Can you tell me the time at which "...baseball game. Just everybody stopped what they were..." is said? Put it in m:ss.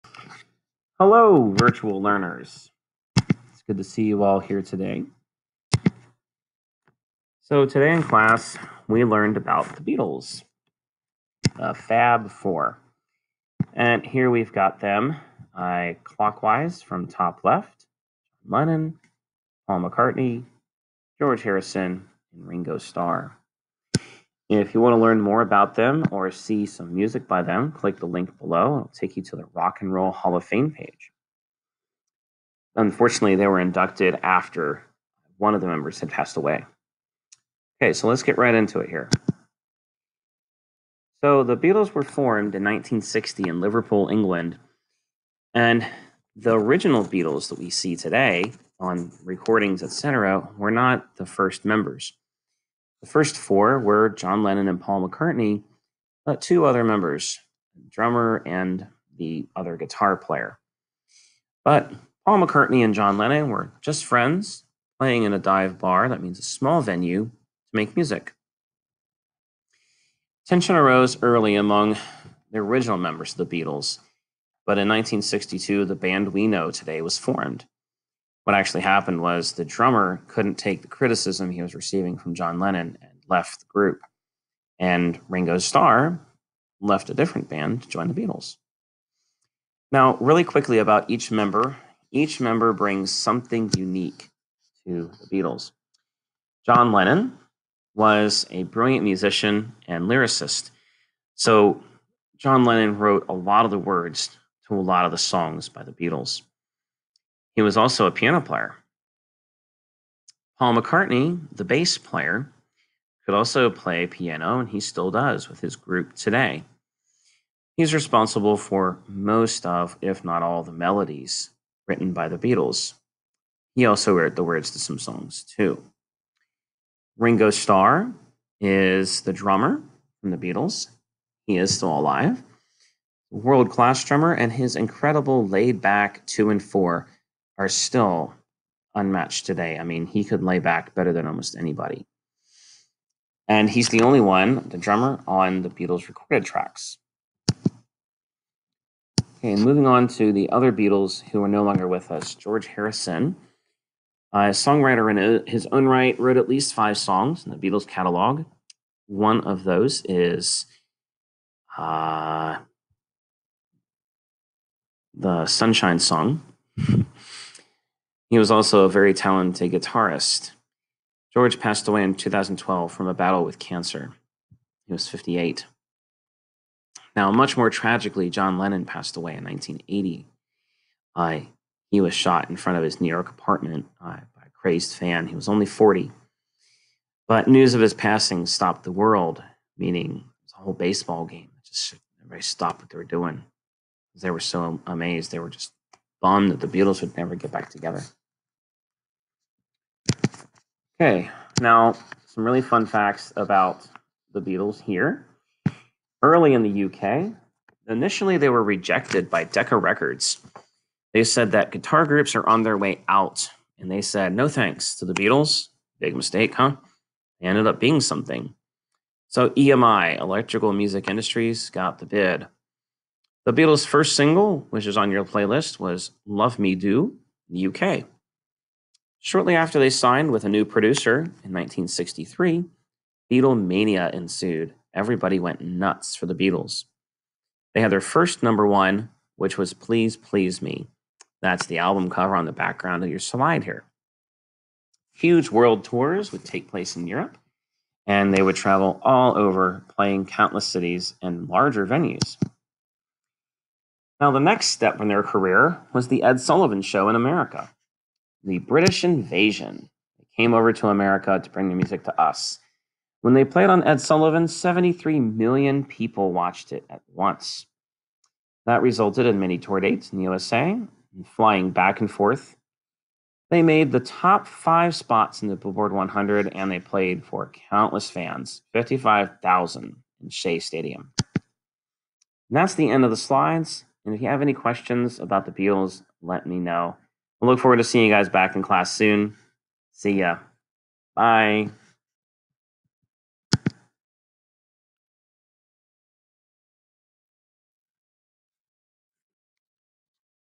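3:10.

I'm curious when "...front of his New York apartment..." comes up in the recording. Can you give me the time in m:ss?
3:02.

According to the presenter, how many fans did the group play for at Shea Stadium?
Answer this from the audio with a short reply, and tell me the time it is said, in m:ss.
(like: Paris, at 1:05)
55,000, at 4:38.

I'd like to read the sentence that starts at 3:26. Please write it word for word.
Early in the UK, initially they were rejected by Decca Records.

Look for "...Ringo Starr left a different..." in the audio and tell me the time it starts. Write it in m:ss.
1:25.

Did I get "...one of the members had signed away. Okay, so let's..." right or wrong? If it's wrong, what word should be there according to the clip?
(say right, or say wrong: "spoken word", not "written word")
wrong: "passed", not "signed".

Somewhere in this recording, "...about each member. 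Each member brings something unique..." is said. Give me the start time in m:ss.
1:30.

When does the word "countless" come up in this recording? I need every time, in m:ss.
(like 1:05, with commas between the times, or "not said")
4:10, 4:37.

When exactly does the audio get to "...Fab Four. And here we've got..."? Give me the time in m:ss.
0:11.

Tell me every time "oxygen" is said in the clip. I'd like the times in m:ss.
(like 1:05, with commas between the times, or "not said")
not said.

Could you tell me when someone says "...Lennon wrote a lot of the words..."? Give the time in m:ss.
1:42.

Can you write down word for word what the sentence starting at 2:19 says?
I mean, he could lay back better than almost anybody.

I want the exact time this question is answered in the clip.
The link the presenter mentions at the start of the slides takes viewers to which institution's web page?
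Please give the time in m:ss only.
0:29.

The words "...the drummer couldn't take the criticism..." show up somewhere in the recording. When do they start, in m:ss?
1:19.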